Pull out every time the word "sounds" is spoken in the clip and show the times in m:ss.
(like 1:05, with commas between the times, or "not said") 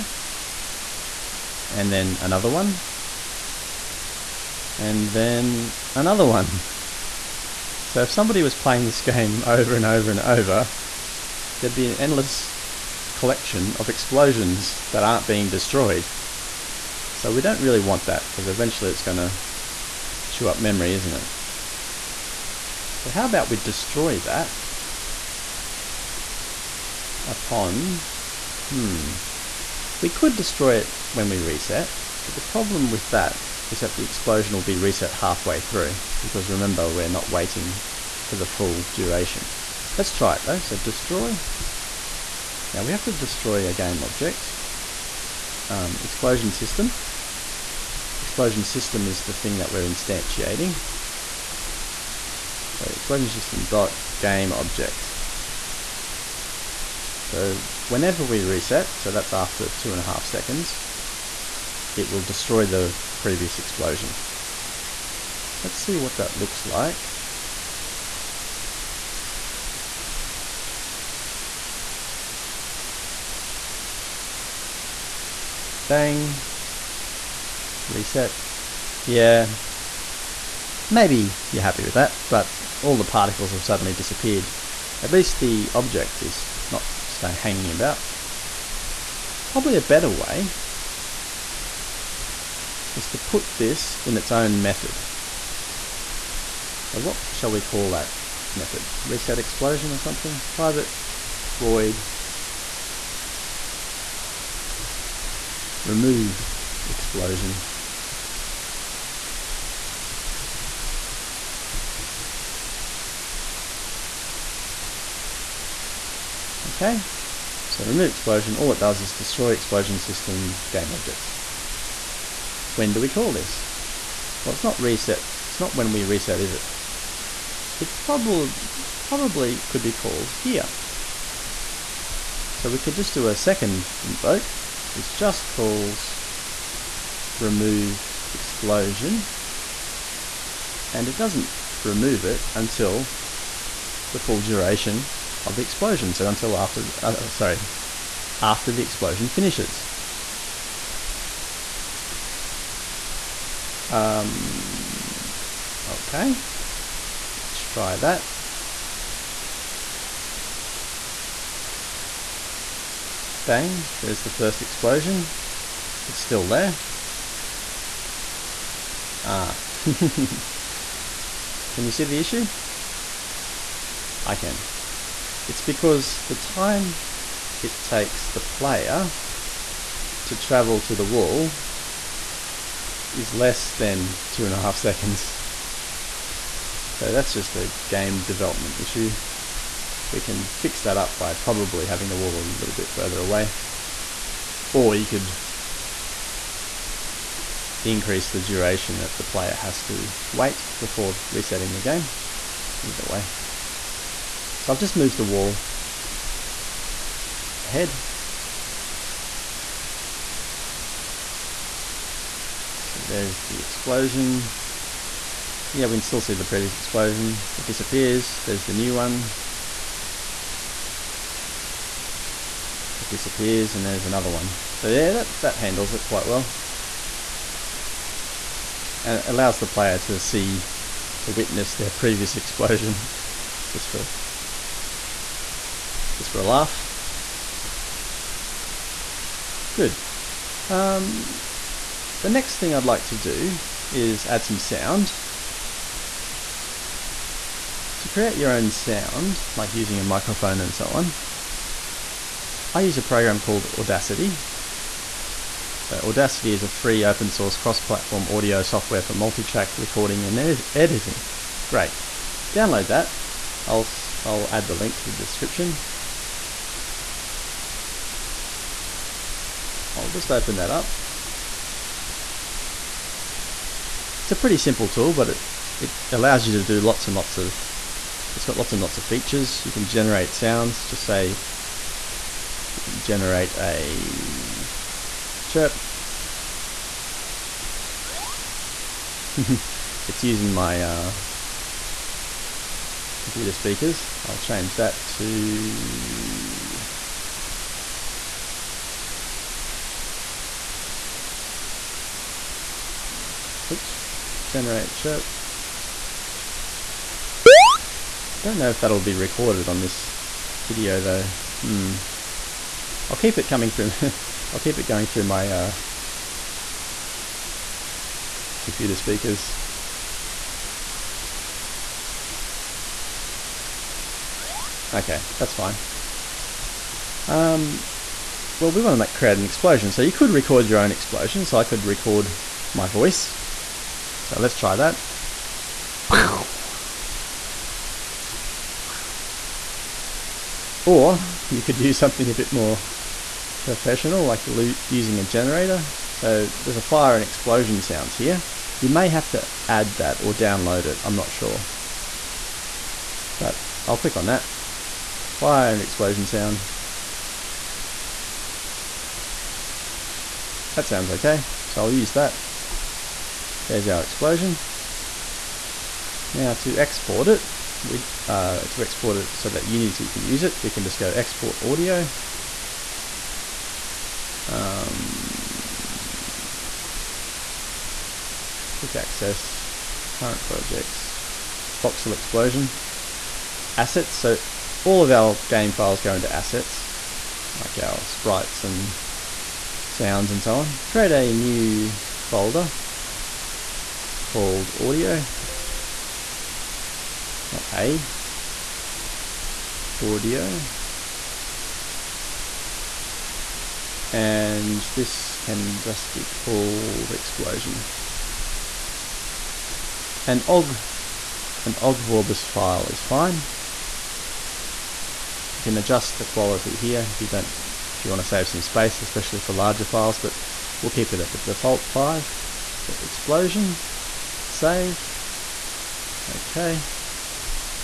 4:04, 4:08, 4:40, 5:47, 5:56, 6:00, 6:29.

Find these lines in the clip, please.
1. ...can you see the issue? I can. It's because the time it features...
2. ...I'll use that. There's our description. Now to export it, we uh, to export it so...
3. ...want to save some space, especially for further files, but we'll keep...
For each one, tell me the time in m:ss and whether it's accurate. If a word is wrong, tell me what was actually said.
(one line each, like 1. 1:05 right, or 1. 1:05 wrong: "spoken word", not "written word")
1. 2:49 wrong: "takes", not "features"
2. 6:01 wrong: "explosion", not "description"
3. 6:58 wrong: "larger", not "further".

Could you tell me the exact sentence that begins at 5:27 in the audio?
Um, well, we want to make, create an explosion, so you could record your own explosion.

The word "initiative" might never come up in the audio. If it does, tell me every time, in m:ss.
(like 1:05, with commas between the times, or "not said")
not said.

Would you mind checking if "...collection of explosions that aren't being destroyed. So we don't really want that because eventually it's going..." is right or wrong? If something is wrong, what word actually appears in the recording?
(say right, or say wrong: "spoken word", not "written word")
right.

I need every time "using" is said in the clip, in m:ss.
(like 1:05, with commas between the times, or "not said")
4:09, 4:50, 5:44.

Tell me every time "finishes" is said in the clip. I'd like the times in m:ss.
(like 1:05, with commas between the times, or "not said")
2:29.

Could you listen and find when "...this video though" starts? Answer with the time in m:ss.
5:09.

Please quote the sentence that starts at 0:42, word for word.
Now we have to destroy a game object.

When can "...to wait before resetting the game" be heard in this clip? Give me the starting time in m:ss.
3:19.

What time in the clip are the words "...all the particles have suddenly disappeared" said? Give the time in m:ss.
1:22.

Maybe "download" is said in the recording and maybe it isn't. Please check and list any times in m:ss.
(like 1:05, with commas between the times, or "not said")
4:22, 5:50.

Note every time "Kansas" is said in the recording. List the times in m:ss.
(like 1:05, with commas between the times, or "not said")
not said.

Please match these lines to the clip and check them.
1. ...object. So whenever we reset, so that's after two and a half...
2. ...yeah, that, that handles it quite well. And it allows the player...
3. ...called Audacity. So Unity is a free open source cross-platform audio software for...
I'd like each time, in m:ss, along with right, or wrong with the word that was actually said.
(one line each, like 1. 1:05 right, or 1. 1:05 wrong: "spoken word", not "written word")
1. 0:54 right
2. 3:44 right
3. 4:13 wrong: "Audacity", not "Unity".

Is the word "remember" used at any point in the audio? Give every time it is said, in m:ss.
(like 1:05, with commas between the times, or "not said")
0:36.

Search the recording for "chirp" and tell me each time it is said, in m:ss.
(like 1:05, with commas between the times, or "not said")
4:45, 5:04.